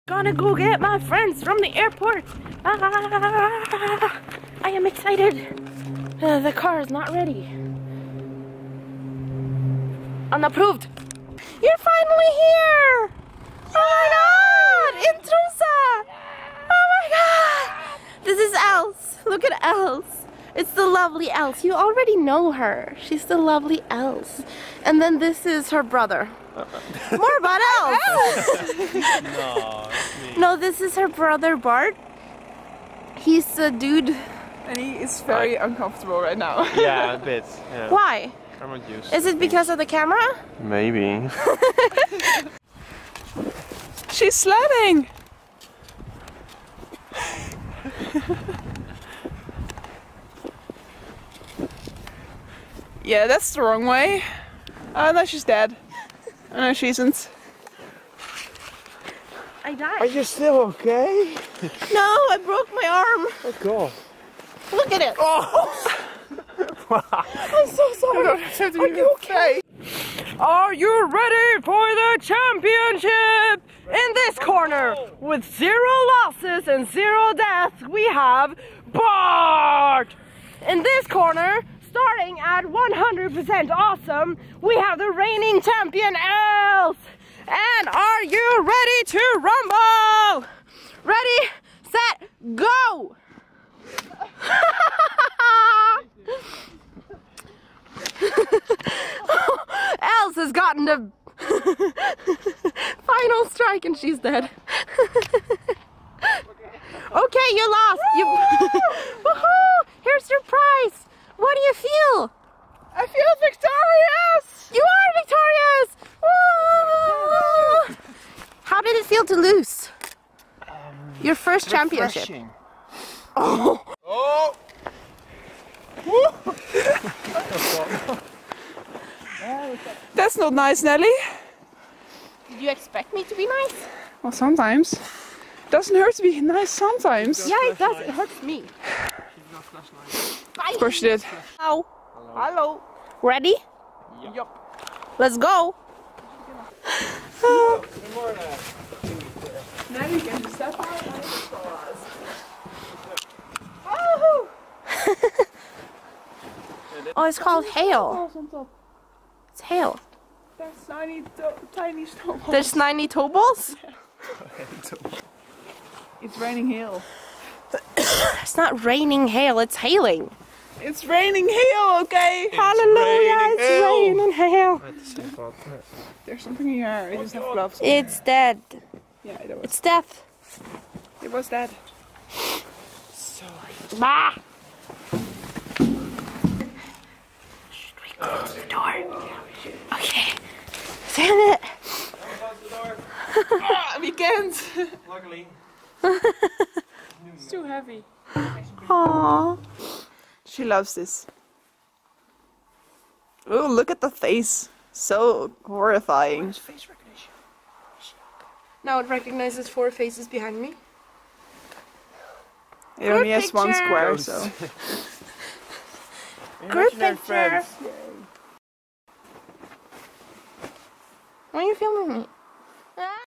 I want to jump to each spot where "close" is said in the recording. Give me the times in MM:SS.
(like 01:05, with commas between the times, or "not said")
03:08, 03:12.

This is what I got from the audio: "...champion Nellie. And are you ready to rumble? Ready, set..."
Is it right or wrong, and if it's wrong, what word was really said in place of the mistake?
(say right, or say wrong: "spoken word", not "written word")
wrong: "Els", not "Nellie".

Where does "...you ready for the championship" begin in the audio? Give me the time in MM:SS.
01:10.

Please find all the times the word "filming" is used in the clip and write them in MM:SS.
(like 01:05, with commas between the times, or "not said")
03:41.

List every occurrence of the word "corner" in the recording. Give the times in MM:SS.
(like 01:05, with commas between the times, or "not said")
01:14, 01:21.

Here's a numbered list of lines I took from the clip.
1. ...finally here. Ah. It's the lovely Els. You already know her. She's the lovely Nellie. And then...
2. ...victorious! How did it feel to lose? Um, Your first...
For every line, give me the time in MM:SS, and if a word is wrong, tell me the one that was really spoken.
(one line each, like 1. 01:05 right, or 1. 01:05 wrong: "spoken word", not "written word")
1. 00:11 wrong: "Els", not "Nellie"
2. 01:57 right.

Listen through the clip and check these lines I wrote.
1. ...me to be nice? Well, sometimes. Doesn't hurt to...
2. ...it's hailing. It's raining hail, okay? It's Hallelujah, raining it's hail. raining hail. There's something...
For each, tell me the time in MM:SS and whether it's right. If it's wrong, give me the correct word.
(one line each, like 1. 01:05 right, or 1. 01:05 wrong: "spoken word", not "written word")
1. 02:13 right
2. 02:49 right.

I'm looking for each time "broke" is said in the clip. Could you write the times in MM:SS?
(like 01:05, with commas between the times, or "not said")
01:02.